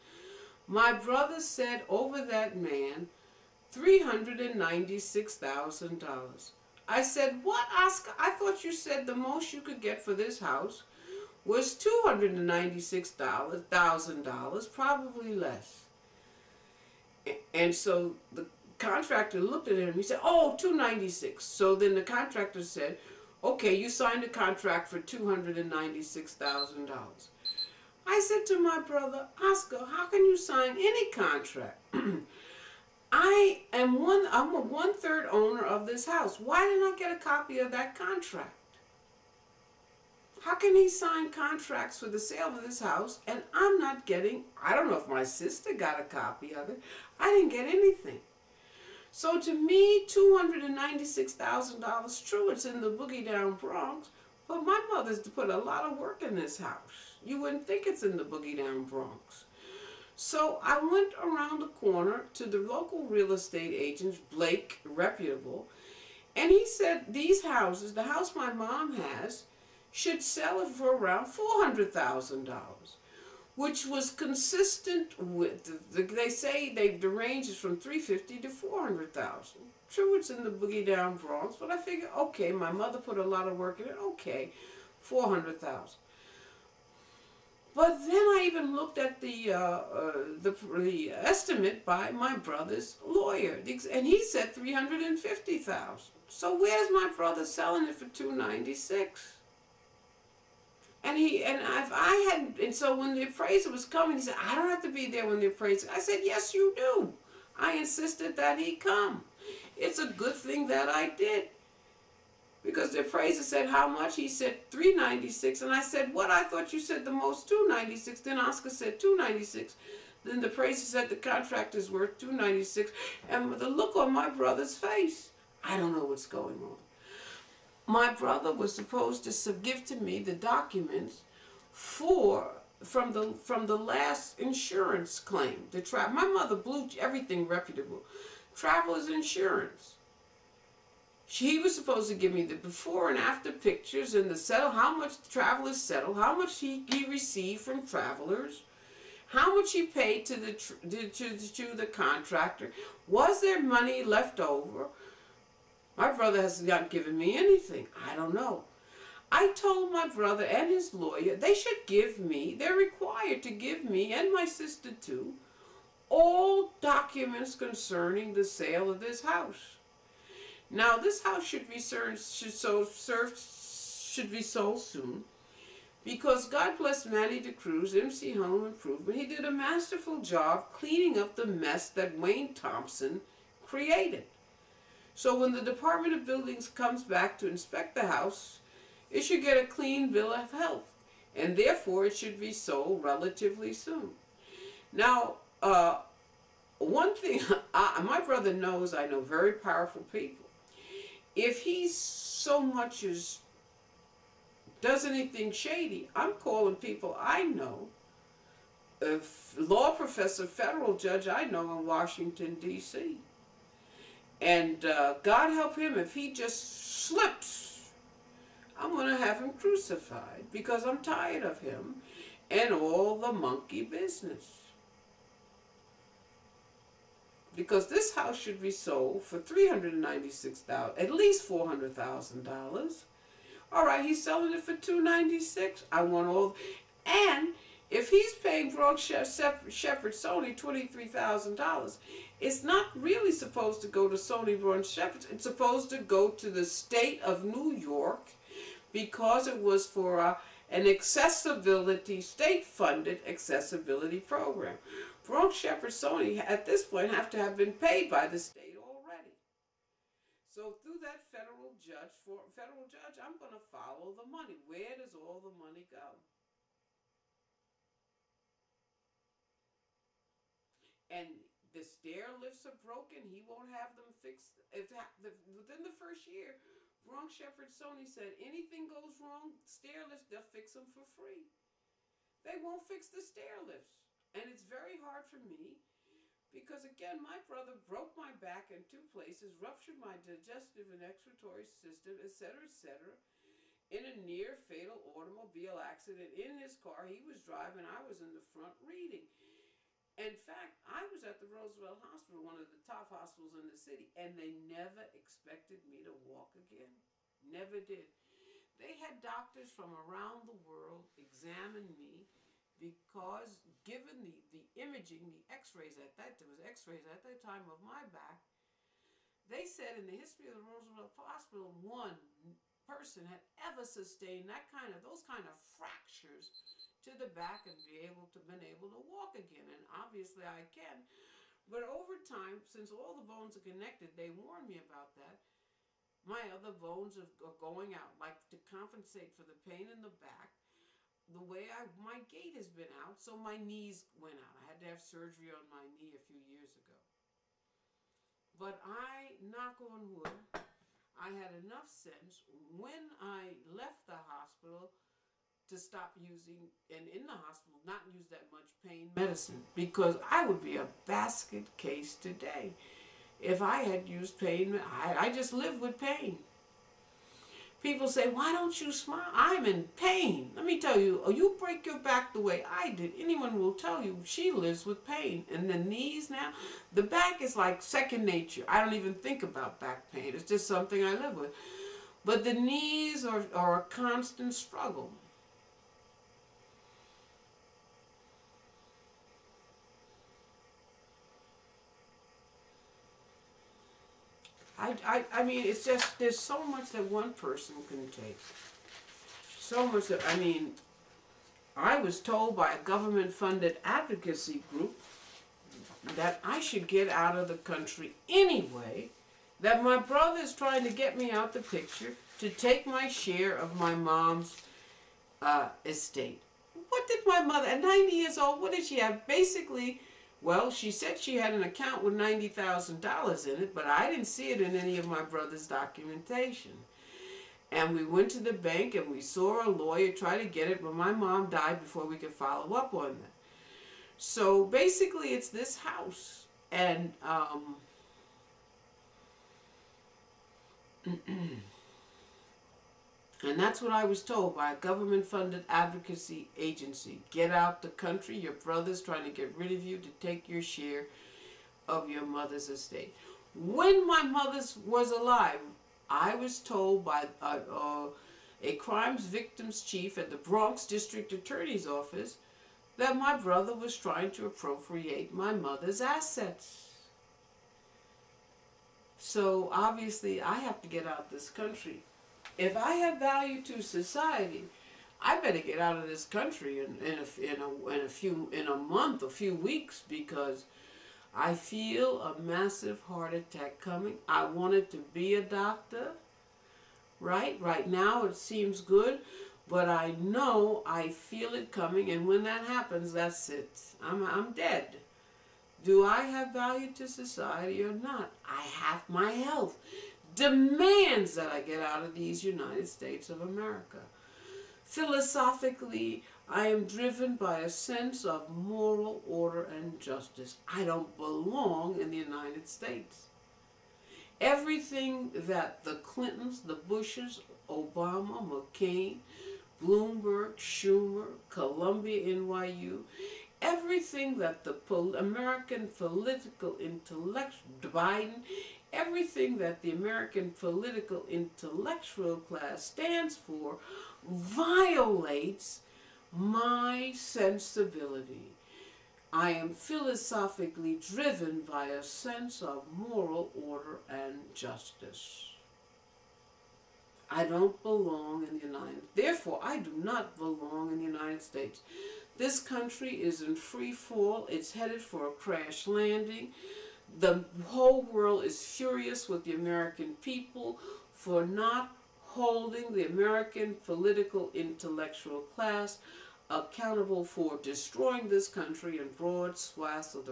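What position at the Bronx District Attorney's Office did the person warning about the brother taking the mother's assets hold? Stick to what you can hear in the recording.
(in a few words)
crimes victims chief.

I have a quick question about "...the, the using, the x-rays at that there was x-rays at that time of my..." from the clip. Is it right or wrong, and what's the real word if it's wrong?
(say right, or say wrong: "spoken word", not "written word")
wrong: "imaging", not "using".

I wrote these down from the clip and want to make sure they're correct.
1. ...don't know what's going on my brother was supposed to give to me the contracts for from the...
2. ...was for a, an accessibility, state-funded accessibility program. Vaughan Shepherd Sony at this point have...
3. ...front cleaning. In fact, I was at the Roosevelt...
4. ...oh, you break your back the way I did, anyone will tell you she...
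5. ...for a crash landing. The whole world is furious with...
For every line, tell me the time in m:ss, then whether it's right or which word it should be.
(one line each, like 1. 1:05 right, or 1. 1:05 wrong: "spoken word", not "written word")
1. 2:05 wrong: "documents", not "contracts"
2. 4:09 right
3. 4:58 wrong: "reading", not "cleaning"
4. 6:11 right
5. 9:15 right.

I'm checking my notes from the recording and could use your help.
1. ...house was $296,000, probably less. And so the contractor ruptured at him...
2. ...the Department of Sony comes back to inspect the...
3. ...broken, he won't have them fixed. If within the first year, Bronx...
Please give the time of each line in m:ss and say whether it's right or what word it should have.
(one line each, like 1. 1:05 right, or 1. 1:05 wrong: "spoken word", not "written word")
1. 0:10 wrong: "looked", not "ruptured"
2. 3:05 wrong: "Buildings", not "Sony"
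3. 4:32 right.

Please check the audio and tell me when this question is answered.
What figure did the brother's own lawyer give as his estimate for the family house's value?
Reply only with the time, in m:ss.
1:34.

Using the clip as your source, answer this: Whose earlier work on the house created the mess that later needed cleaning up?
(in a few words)
Wayne Thompson.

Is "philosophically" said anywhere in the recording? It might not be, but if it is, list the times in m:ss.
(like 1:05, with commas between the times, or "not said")
8:24, 8:59.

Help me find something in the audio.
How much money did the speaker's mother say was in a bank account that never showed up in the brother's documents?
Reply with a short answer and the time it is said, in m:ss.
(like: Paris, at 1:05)
$90,000, at 7:02.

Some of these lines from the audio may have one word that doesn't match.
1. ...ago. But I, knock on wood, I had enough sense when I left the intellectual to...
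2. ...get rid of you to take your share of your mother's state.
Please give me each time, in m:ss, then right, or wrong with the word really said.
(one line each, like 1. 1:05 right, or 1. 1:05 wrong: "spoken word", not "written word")
1. 5:46 wrong: "hospital", not "intellectual"
2. 7:29 wrong: "estate", not "state".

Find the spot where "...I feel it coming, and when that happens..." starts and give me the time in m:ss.
8:10.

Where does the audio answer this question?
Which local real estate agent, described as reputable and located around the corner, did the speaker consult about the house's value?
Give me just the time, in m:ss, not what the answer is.
1:04.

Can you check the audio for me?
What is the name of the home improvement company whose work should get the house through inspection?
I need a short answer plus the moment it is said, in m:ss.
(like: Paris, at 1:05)
MC Home Improvement, at 2:57.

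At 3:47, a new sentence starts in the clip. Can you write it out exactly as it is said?
Because this house should be sold for $396,000, at least $400,000.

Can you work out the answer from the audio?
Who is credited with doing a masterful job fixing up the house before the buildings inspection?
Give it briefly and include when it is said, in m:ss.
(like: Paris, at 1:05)
Manny de Cruz, at 2:57.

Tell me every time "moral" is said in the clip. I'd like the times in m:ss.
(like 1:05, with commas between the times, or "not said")
8:28, 9:02.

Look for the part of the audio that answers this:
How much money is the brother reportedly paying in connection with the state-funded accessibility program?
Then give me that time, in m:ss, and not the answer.
4:00.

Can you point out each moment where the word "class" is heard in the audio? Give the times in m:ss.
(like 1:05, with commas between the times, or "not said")
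8:52, 9:25.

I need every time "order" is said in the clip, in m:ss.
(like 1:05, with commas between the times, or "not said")
8:29, 9:03.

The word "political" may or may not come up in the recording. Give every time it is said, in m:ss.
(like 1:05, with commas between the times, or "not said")
8:45, 8:50, 9:23.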